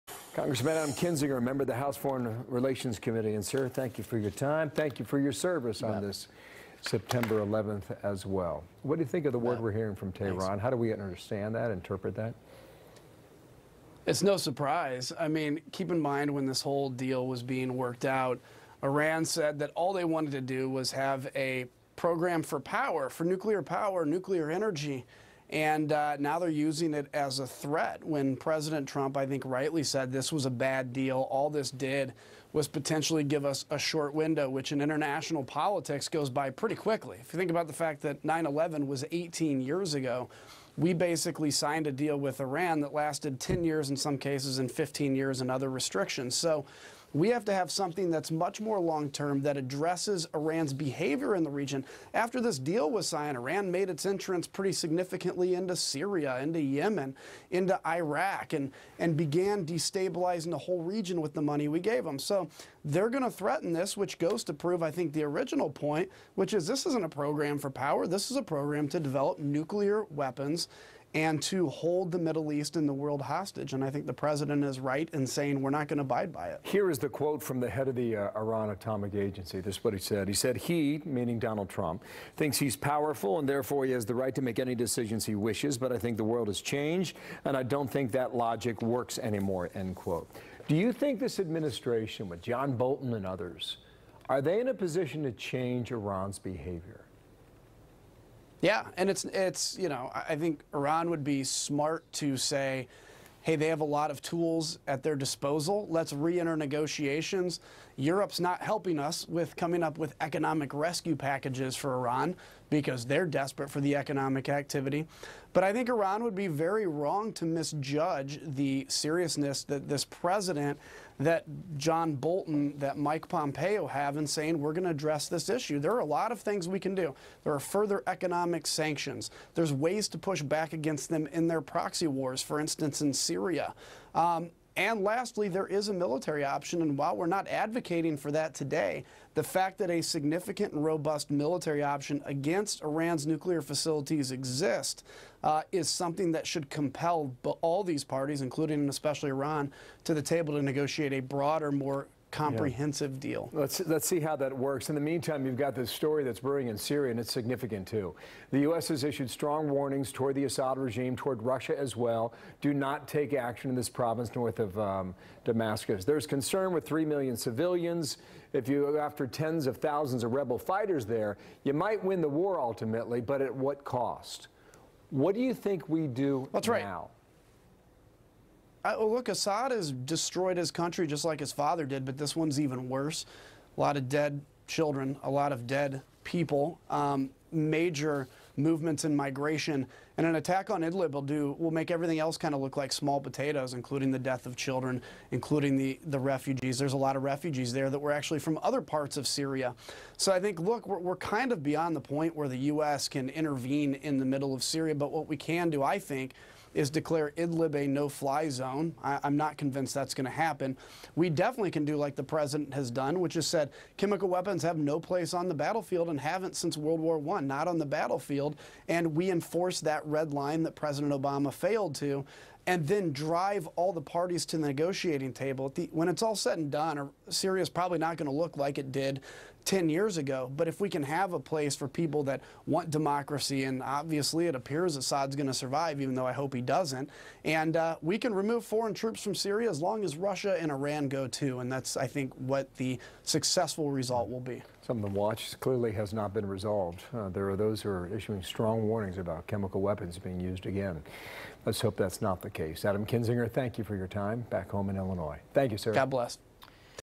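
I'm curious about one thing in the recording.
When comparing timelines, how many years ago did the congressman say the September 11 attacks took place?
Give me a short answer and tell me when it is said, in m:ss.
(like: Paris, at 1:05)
18, at 0:39.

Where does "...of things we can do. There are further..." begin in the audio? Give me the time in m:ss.
2:06.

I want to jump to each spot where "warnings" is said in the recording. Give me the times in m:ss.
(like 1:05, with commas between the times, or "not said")
2:39, 4:08.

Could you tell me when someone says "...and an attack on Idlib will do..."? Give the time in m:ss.
3:10.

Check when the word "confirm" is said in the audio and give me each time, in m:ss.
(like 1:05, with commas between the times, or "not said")
not said.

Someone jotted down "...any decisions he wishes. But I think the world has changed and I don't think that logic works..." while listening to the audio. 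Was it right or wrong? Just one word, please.
right.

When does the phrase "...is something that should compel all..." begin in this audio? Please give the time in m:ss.
2:25.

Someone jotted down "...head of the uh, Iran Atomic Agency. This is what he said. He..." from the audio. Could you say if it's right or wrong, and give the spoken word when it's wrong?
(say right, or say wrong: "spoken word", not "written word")
right.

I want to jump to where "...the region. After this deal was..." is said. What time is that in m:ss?
0:51.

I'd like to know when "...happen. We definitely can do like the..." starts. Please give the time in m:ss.
3:30.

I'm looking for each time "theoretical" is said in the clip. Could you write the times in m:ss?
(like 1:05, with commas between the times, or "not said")
not said.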